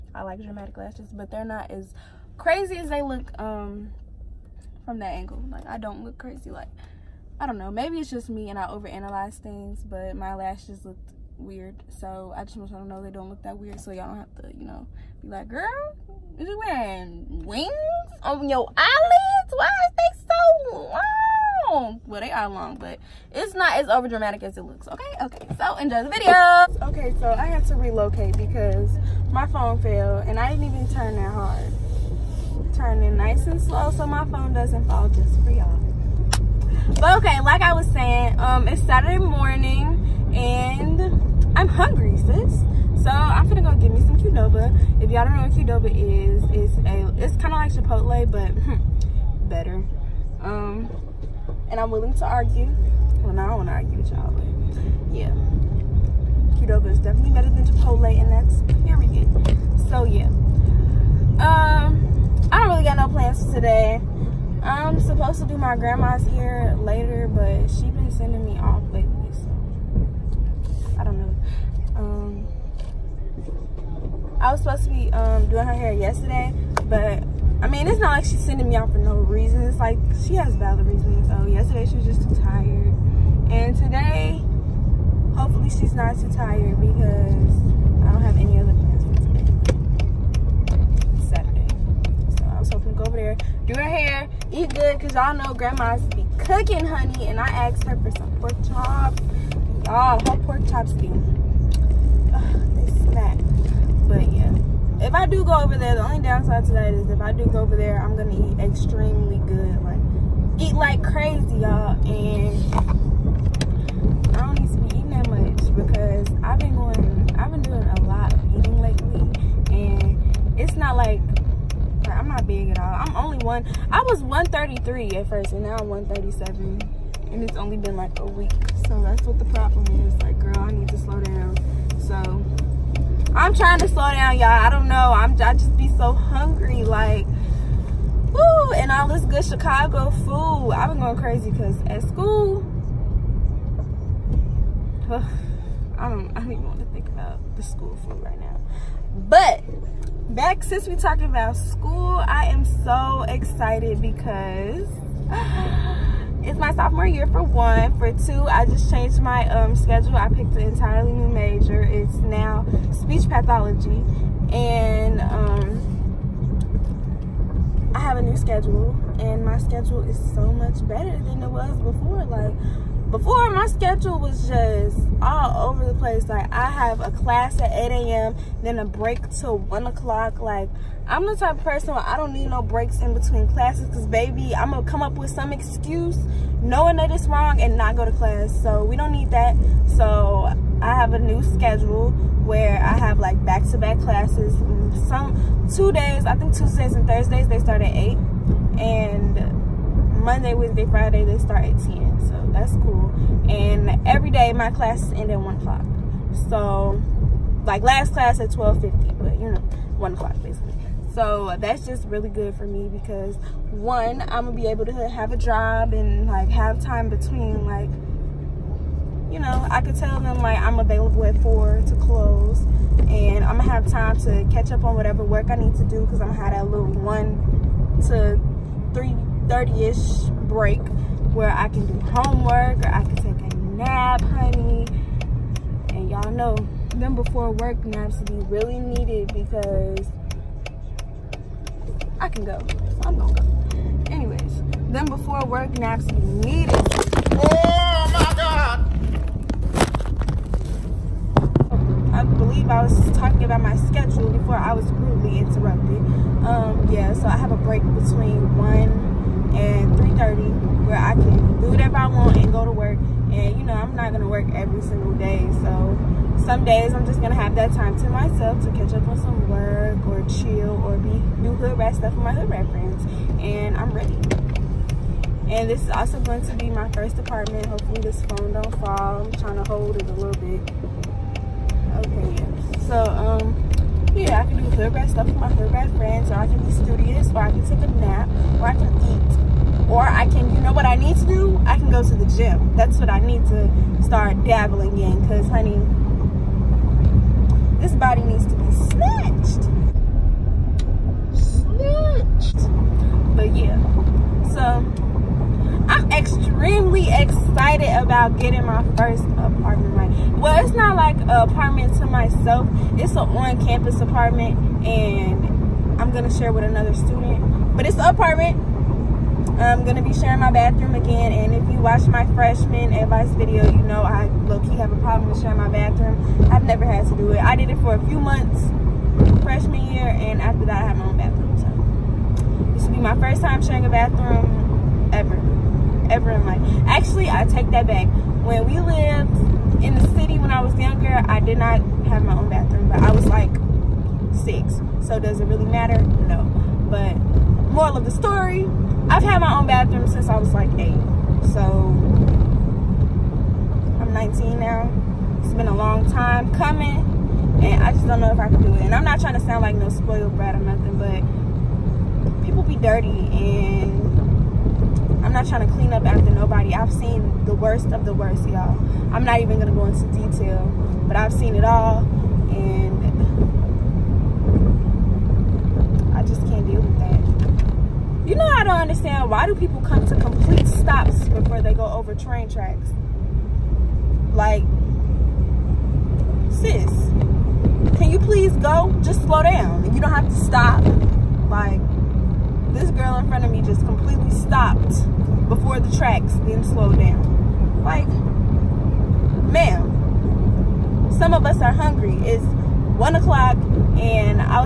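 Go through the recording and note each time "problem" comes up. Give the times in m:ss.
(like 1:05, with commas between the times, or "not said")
2:09, 5:24.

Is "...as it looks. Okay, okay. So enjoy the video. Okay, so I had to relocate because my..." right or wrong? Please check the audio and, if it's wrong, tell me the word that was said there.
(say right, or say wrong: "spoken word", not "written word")
right.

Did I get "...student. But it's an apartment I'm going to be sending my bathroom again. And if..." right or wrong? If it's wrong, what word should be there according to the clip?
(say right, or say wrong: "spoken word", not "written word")
wrong: "sharing", not "sending".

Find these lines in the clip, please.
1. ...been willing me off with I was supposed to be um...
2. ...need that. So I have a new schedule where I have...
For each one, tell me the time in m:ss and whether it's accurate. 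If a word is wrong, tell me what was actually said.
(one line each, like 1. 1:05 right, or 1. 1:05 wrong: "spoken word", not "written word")
1. 1:07 wrong: "sending", not "willing"
2. 3:09 right.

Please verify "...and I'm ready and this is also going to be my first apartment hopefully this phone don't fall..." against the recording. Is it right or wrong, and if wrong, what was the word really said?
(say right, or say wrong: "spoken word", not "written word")
right.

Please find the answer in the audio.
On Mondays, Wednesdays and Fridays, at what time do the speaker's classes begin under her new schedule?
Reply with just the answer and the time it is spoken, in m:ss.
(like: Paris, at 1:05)
10, at 3:18.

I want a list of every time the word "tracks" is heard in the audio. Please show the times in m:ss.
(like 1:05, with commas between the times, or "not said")
6:22, 6:35.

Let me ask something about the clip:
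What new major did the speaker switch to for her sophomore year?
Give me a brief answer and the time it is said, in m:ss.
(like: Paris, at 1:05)
speech pathology, at 2:41.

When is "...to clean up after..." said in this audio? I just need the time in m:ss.
6:05.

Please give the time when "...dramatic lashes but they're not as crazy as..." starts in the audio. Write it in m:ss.
0:00.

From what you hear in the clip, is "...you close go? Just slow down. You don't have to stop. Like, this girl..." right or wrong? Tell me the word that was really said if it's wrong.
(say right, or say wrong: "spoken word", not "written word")
wrong: "please", not "close".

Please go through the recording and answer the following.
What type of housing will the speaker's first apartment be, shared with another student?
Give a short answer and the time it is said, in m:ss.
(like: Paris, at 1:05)
on-campus apartment, at 5:12.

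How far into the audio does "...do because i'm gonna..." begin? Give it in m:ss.
3:45.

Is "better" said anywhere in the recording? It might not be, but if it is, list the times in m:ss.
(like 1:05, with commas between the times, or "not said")
0:49, 0:57, 2:50.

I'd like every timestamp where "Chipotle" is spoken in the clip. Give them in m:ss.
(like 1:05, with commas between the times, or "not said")
0:47, 0:57.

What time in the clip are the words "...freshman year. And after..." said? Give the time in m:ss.
5:29.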